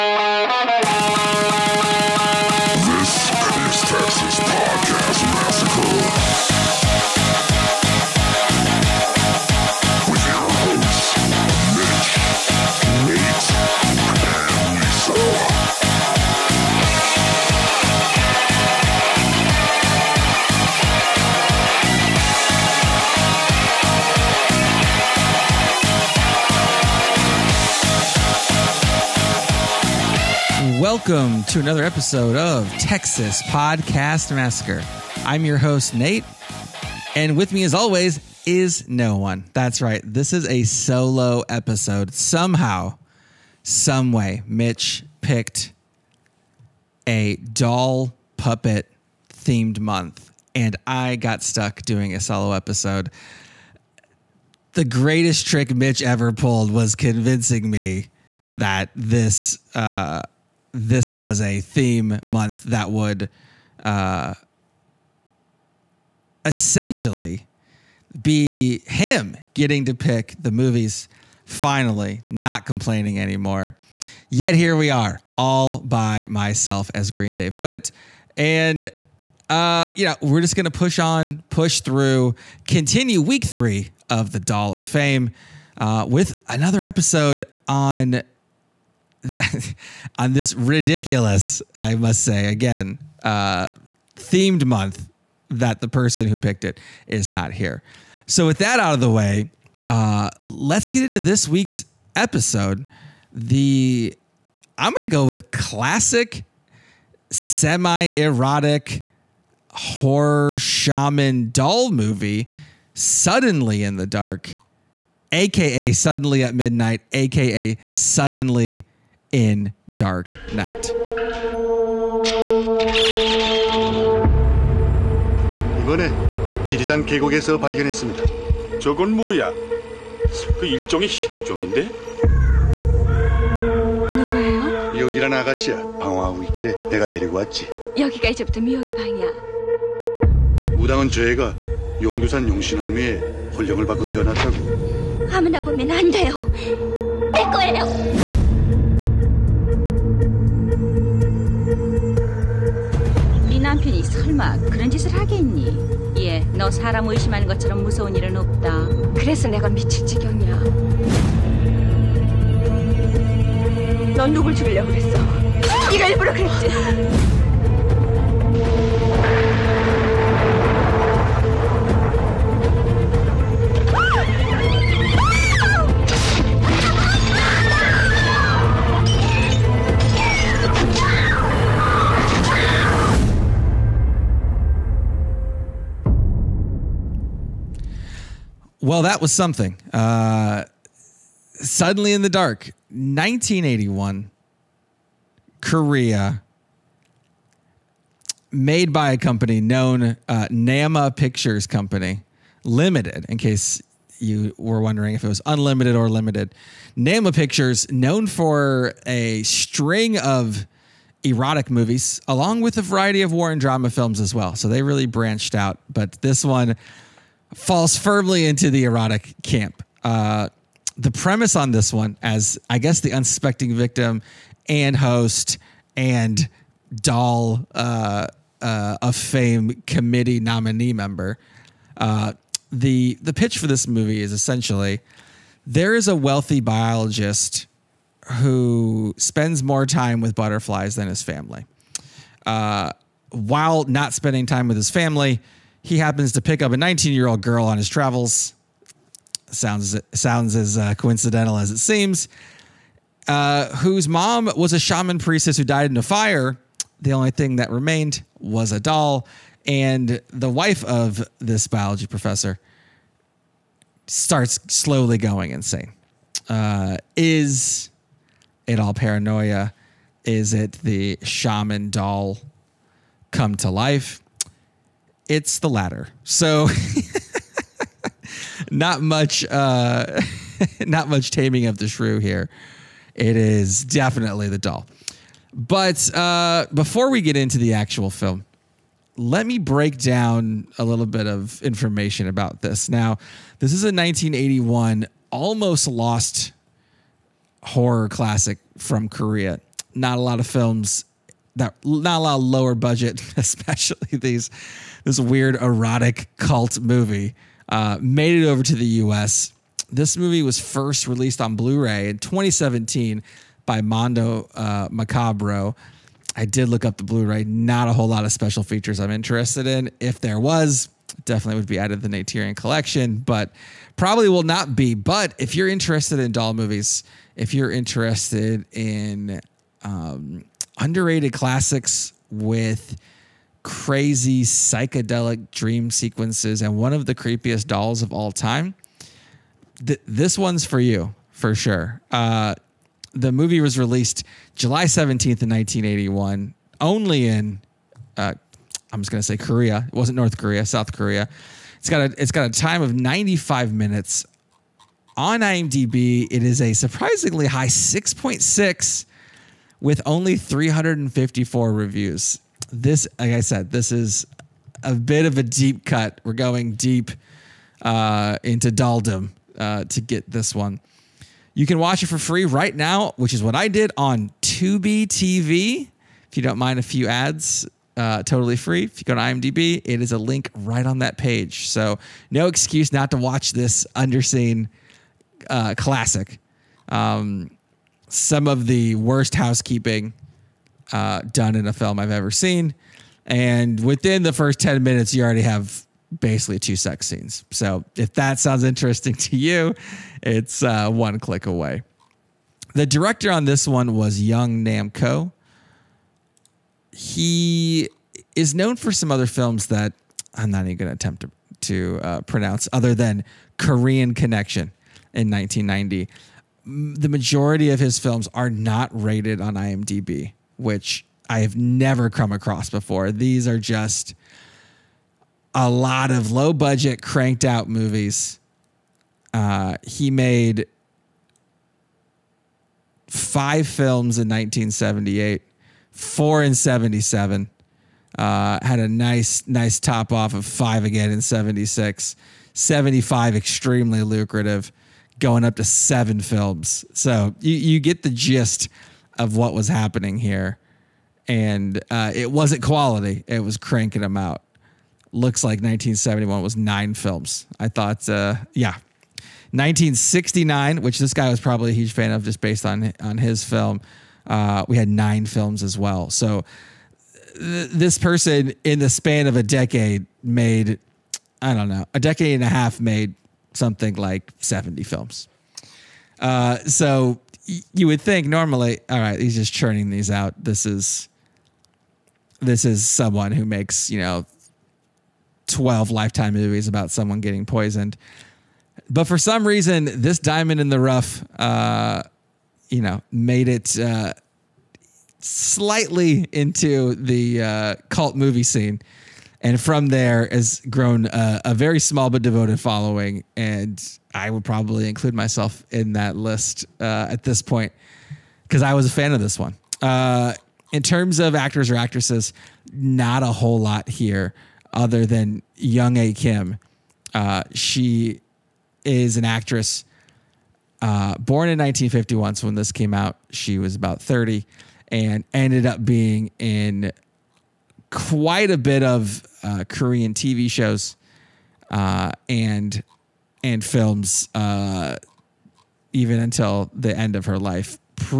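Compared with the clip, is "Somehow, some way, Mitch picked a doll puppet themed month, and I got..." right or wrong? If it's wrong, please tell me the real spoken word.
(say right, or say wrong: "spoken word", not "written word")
right.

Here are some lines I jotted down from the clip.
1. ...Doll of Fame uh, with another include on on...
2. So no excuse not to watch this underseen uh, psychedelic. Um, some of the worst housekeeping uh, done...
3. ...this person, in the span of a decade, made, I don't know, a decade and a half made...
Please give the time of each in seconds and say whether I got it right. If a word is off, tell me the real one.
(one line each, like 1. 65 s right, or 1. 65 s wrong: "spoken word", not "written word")
1. 84 s wrong: "episode", not "include"
2. 381 s wrong: "classic", not "psychedelic"
3. 467 s right.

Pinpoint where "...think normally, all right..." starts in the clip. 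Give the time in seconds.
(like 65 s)
478 s.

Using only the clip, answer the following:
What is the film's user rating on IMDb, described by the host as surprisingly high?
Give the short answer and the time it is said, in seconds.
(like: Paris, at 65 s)
6.6, at 357 s.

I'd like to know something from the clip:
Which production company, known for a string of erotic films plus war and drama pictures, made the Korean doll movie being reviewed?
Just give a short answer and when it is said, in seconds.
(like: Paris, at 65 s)
Nama Pictures Company Limited, at 200 s.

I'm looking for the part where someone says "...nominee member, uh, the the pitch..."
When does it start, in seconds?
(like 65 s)
230 s.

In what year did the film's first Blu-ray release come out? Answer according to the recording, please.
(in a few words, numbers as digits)
2017.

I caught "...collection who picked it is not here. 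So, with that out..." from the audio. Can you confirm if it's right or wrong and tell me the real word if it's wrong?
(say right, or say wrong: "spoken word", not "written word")
wrong: "person", not "collection".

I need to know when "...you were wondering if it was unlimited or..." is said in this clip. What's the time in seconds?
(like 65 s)
204 s.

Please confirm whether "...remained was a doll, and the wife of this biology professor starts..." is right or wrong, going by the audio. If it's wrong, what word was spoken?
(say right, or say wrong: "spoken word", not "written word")
right.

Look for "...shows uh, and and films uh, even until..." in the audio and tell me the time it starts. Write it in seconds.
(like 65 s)
530 s.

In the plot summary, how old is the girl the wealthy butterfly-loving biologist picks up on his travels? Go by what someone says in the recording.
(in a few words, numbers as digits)
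19.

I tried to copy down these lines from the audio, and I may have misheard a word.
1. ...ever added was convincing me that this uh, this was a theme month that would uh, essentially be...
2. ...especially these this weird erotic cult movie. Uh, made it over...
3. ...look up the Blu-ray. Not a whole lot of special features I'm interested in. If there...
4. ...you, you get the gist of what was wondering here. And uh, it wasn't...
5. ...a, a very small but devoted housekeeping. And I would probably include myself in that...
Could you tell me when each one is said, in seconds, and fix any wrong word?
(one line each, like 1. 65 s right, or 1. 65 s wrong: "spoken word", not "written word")
1. 56 s wrong: "pulled", not "added"
2. 303 s right
3. 316 s right
4. 447 s wrong: "happening", not "wondering"
5. 501 s wrong: "following", not "housekeeping".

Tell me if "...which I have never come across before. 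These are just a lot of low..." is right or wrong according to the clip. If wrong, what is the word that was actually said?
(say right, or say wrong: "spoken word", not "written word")
right.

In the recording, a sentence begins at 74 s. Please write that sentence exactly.
Yet here we are, all by myself, as Green Day put it.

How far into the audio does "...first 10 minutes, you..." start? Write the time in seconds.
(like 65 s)
394 s.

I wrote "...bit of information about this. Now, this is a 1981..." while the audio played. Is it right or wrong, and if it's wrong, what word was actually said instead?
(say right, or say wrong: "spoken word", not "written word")
right.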